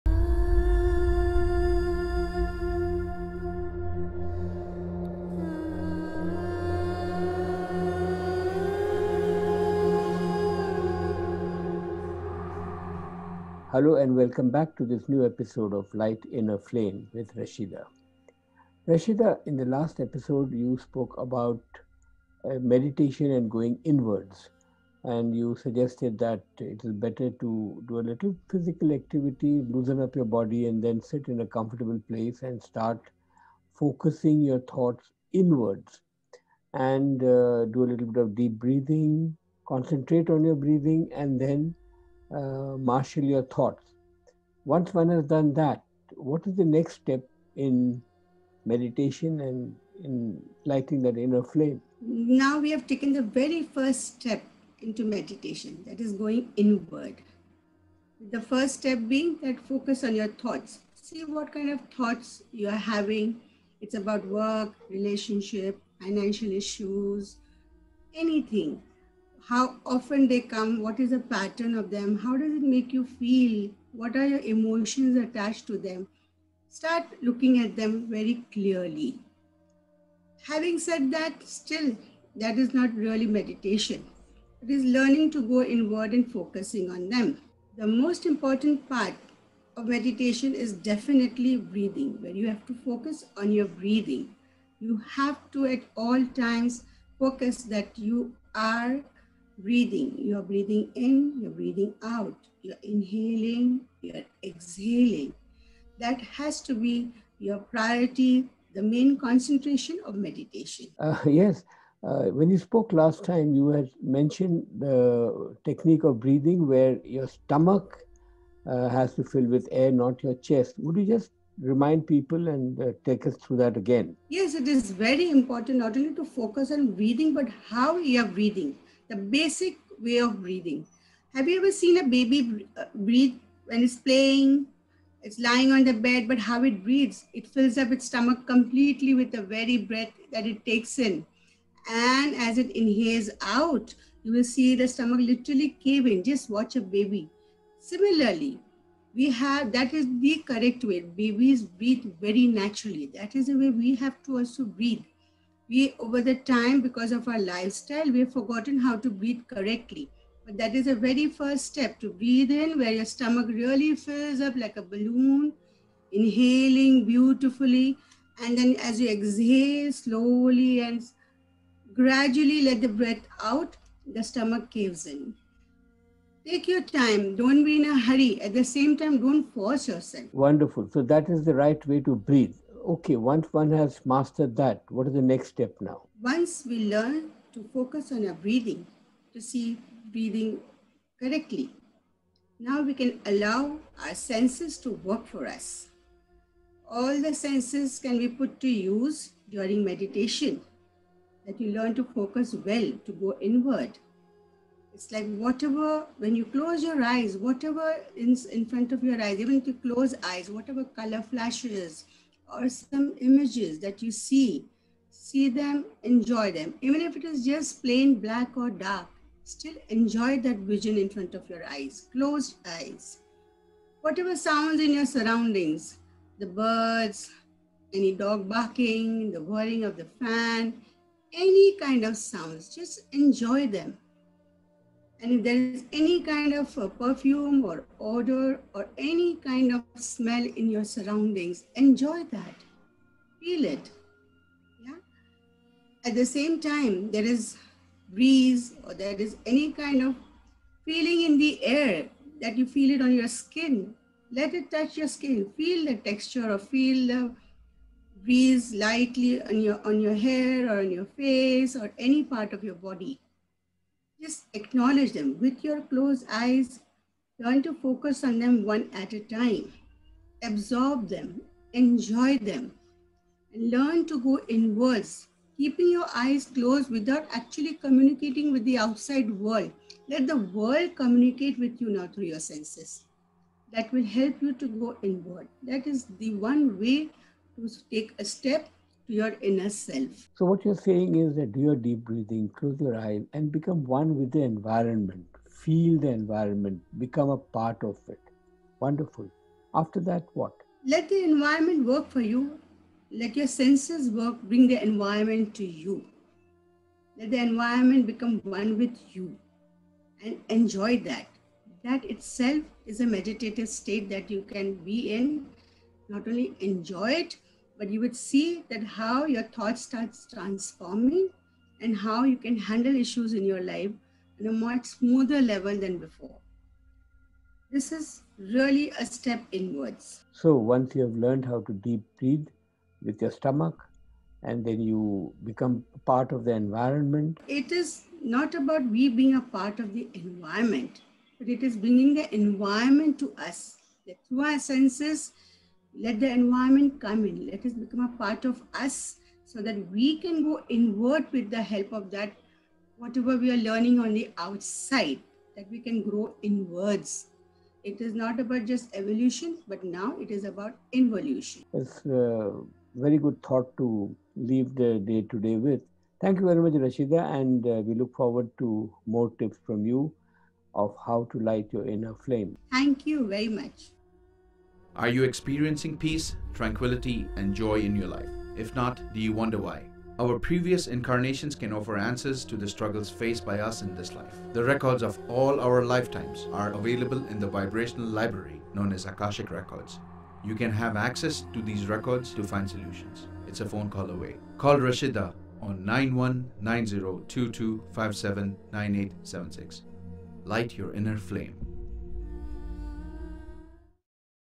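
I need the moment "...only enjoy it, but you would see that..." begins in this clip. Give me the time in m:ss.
5:16.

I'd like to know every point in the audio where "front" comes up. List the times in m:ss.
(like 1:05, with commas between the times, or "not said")
3:28, 3:41.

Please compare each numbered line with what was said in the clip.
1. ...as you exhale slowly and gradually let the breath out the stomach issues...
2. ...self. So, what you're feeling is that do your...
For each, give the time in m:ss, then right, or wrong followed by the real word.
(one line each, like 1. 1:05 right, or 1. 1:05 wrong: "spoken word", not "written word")
1. 2:48 wrong: "caves", not "issues"
2. 4:49 wrong: "saying", not "feeling".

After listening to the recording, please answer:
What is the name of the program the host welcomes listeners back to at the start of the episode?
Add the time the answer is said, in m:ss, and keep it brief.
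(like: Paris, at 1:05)
Light in a Flame, at 0:15.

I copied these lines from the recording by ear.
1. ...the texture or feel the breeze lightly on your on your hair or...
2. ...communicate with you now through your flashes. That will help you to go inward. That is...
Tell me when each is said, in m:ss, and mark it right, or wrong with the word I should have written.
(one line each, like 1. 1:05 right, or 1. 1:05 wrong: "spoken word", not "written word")
1. 4:15 right
2. 4:40 wrong: "senses", not "flashes".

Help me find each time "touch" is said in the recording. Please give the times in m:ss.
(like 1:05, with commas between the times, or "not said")
4:14.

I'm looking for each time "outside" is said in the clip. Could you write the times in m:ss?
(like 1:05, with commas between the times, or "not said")
4:38, 5:54.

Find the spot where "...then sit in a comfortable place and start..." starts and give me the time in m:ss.
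0:30.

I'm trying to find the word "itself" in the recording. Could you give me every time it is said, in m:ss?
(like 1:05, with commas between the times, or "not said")
5:12.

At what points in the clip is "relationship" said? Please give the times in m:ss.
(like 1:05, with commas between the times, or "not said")
1:04.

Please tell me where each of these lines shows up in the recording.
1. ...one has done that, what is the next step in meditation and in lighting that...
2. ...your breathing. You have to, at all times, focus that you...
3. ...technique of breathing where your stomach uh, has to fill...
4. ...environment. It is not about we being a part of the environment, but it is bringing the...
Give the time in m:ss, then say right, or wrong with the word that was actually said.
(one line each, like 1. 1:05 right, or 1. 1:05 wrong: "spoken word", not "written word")
1. 0:44 right
2. 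1:33 right
3. 1:55 right
4. 5:36 right.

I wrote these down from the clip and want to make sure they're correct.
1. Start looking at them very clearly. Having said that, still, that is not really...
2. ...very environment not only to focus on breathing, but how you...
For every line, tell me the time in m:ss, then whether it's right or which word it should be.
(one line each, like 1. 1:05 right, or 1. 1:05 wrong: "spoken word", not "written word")
1. 1:16 right
2. 2:04 wrong: "important", not "environment".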